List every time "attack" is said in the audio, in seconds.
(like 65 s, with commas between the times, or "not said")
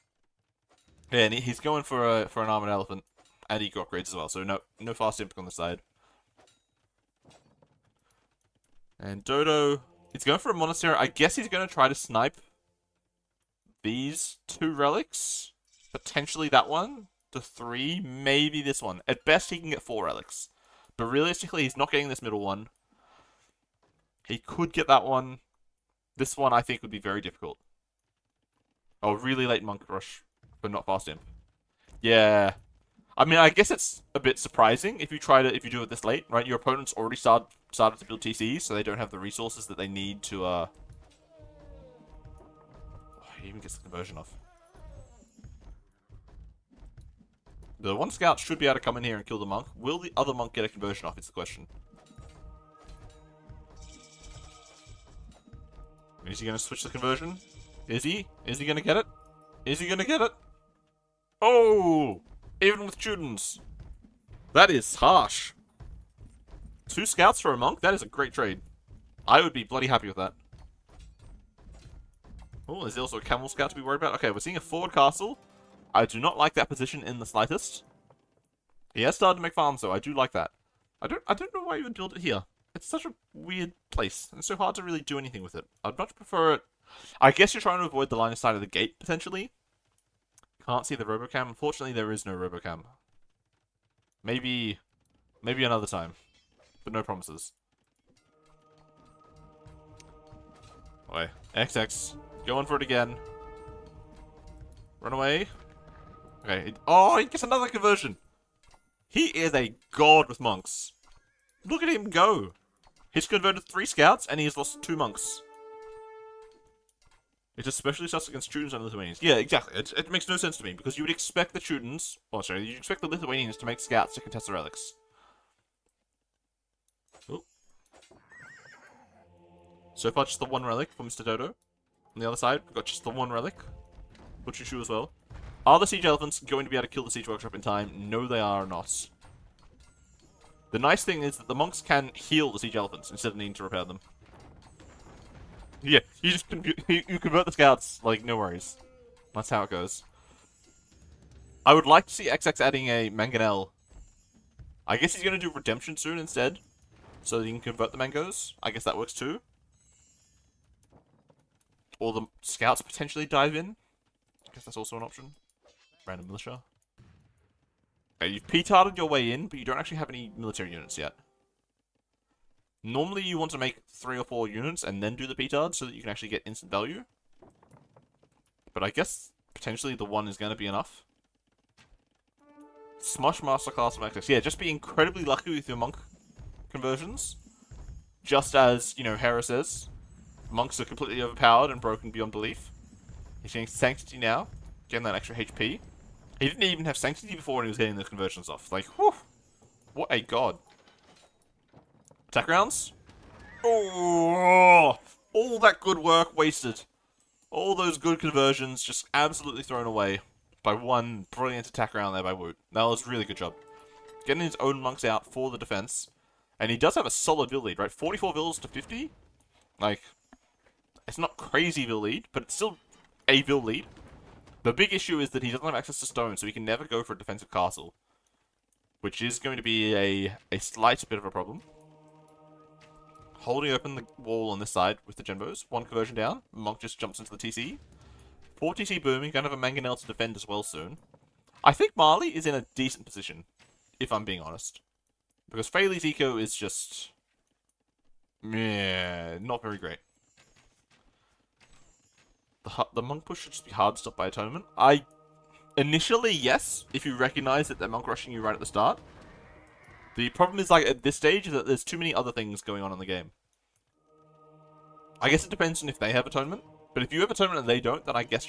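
202 s, 211 s.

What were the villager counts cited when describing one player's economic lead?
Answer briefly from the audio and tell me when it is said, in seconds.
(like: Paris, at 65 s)
44 to 50, at 217 s.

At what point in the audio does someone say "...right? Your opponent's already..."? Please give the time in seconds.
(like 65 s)
36 s.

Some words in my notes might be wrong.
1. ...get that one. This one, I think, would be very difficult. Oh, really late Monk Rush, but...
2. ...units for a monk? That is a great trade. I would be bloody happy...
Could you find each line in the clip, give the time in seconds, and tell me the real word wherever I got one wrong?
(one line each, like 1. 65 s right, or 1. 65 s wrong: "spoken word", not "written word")
1. 24 s right
2. 67 s wrong: "scouts", not "units".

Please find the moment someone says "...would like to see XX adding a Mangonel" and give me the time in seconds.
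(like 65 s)
151 s.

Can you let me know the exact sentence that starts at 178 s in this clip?
But I guess potentially the one is going to be enough.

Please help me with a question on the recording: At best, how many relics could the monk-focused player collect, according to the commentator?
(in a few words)
4.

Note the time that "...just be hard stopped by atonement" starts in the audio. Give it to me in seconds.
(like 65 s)
253 s.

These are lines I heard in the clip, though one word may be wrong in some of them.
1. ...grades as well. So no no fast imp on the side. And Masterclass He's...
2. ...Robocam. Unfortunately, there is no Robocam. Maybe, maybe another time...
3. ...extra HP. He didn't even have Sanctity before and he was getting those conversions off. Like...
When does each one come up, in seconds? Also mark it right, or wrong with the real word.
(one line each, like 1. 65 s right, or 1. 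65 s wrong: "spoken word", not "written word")
1. 3 s wrong: "Dodo", not "Masterclass"
2. 91 s right
3. 195 s right.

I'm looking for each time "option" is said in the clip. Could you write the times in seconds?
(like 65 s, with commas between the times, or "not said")
165 s.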